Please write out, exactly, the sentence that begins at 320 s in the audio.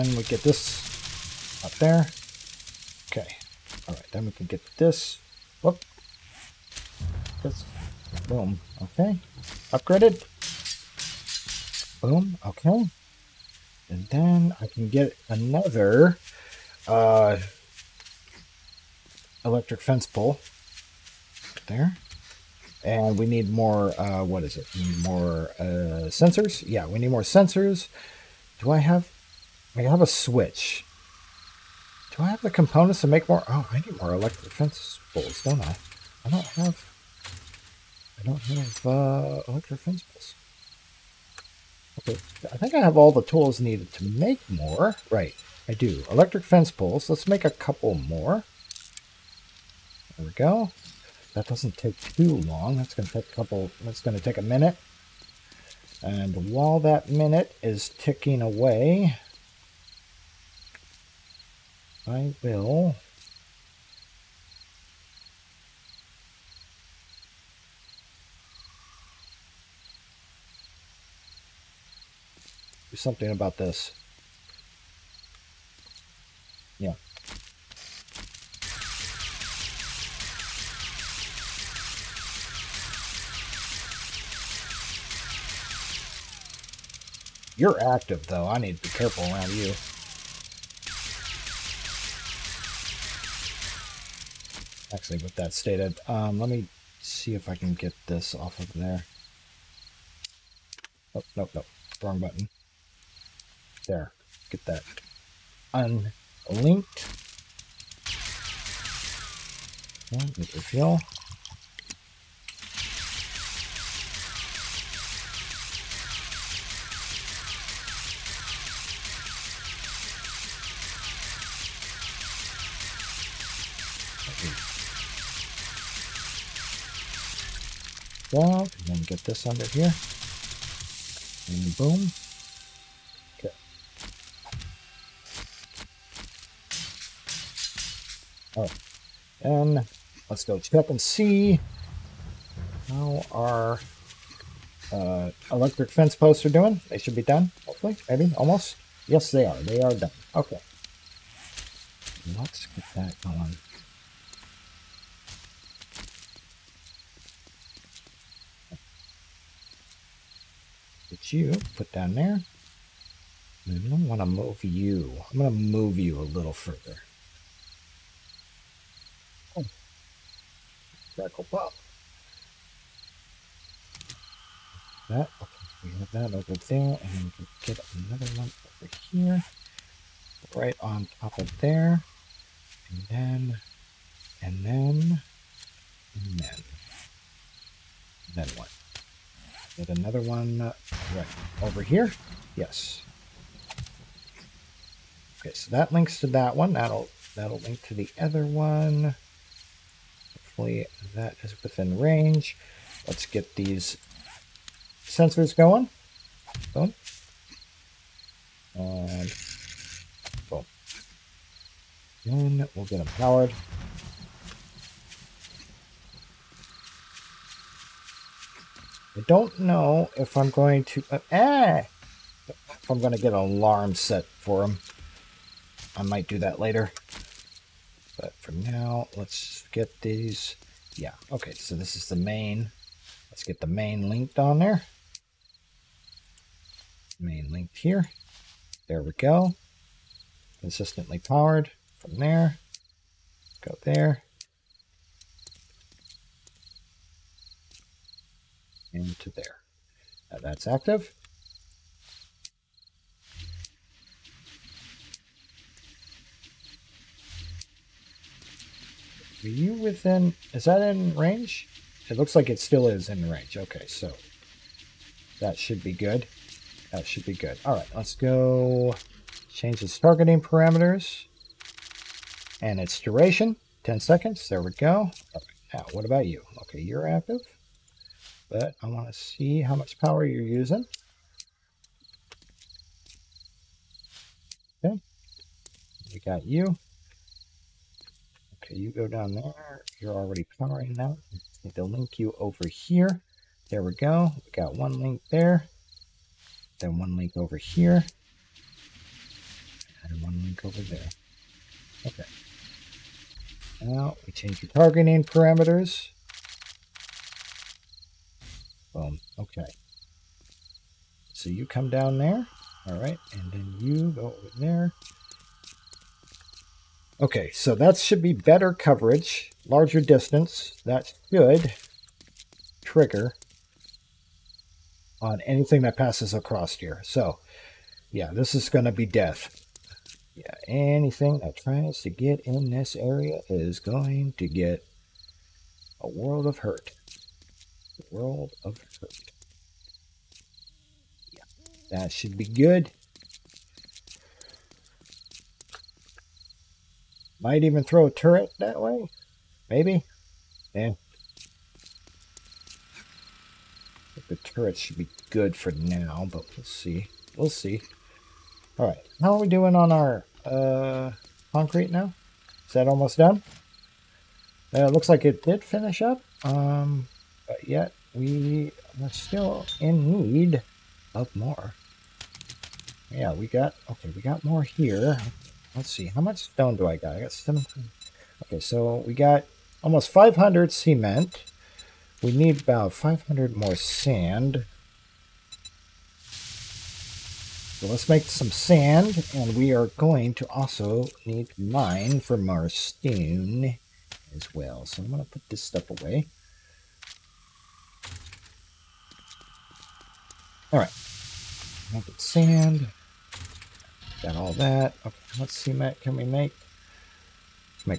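That should trigger on anything that passes across here.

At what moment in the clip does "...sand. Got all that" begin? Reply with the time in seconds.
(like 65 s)
402 s.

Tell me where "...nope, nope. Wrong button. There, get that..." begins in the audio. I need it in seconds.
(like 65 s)
101 s.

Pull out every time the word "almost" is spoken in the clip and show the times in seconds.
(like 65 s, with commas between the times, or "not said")
148 s, 362 s, 379 s.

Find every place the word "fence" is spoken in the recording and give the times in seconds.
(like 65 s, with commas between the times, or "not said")
19 s, 34 s, 39 s, 46 s, 145 s.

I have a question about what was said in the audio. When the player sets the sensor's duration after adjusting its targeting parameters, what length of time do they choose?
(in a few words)
10 seconds.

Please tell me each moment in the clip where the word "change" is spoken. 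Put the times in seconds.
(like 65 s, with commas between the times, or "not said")
269 s, 304 s.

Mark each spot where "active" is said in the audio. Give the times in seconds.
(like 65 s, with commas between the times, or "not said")
87 s, 250 s, 277 s.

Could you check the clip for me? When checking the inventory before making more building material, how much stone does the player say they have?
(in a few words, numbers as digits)
17.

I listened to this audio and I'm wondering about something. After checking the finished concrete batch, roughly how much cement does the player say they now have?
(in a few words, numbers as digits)
500.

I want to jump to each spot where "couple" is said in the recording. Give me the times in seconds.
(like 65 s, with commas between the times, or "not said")
47 s, 53 s.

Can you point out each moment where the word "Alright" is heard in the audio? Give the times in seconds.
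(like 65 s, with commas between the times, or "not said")
3 s, 358 s.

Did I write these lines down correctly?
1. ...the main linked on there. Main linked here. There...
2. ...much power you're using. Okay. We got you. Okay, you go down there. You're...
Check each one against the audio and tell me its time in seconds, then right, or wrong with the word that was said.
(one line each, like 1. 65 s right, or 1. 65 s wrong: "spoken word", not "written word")
1. 233 s right
2. 279 s right.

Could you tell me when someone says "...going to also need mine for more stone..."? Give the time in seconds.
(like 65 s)
389 s.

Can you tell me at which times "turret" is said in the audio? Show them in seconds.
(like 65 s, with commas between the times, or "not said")
348 s, 354 s.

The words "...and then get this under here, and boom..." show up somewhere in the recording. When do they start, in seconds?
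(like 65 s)
128 s.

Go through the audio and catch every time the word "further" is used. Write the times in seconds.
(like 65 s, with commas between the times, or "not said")
166 s.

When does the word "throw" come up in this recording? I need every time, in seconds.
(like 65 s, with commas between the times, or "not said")
347 s.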